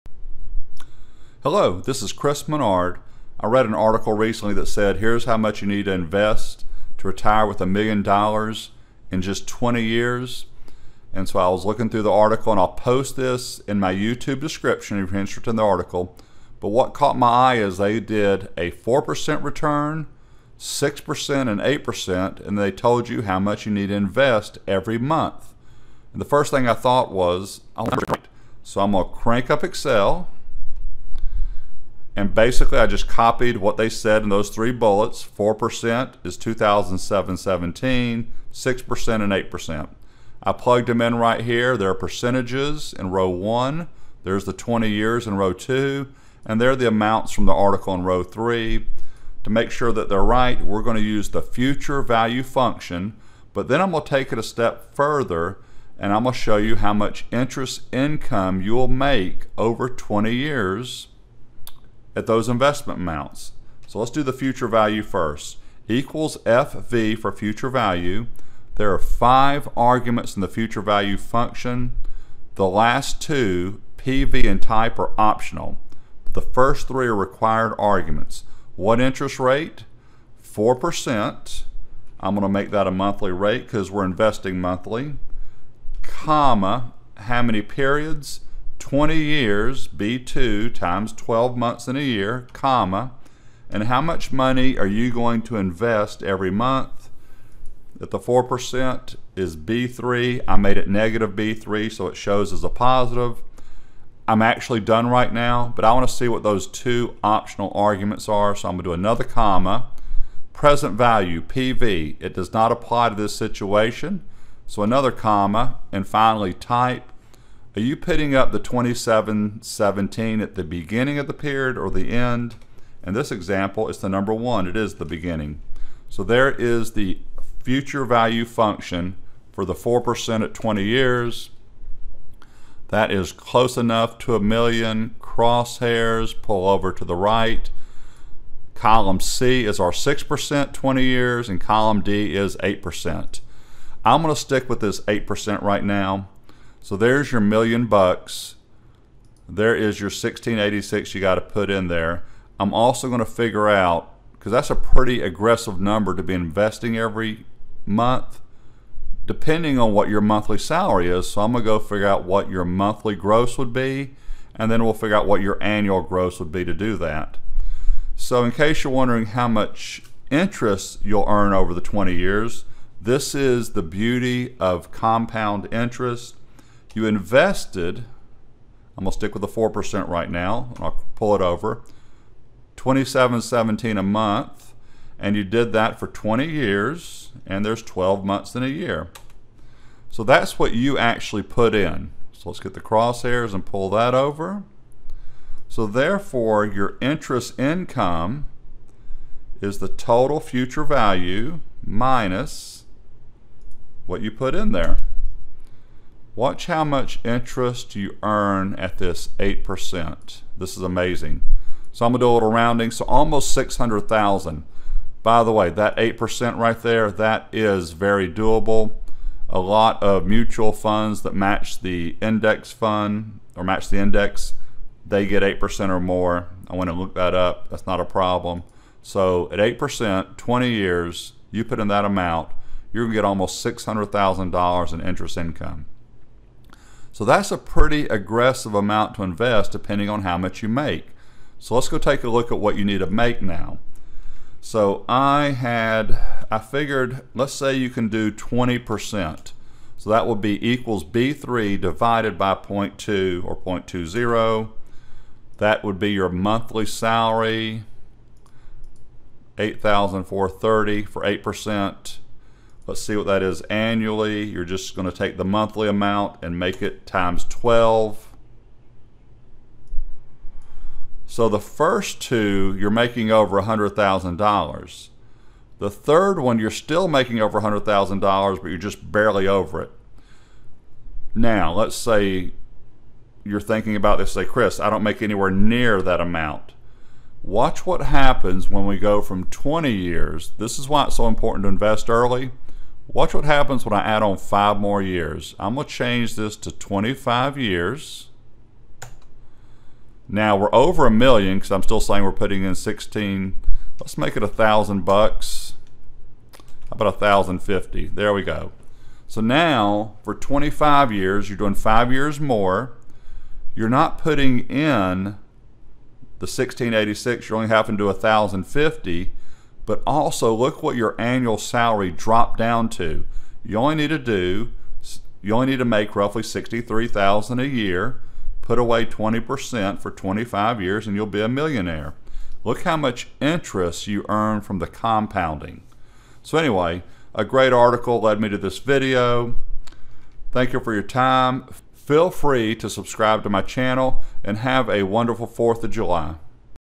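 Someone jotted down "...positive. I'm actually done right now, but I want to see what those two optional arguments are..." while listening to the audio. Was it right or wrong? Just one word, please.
right.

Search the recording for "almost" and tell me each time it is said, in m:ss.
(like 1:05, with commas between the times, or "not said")
3:33, 3:53.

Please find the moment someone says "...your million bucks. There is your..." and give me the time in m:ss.
2:27.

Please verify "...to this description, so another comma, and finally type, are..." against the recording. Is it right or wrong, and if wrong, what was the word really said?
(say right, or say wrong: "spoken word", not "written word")
wrong: "situation", not "description".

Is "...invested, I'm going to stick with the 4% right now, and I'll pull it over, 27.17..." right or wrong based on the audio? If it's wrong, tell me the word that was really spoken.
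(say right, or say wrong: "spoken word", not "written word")
right.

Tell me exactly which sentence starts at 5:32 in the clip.
Look how much interest you earn from the compounding.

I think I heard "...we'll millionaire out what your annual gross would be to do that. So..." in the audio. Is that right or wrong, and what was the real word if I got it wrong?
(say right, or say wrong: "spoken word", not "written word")
wrong: "figure", not "millionaire".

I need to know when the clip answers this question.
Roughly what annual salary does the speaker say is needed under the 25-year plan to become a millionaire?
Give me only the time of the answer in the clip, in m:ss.
5:26.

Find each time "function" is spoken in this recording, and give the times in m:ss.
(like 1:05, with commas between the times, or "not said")
0:52, 1:11, 2:08.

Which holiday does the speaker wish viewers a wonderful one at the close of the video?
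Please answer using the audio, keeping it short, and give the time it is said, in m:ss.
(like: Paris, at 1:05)
4th of July, at 5:45.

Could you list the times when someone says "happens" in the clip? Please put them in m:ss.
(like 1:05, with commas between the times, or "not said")
4:48, 4:53.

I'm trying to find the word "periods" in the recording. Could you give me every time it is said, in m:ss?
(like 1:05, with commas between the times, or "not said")
1:27, 2:01.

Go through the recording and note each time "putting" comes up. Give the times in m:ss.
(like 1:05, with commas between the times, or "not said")
1:57, 5:02, 5:14.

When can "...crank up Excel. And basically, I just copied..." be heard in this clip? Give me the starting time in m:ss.
0:29.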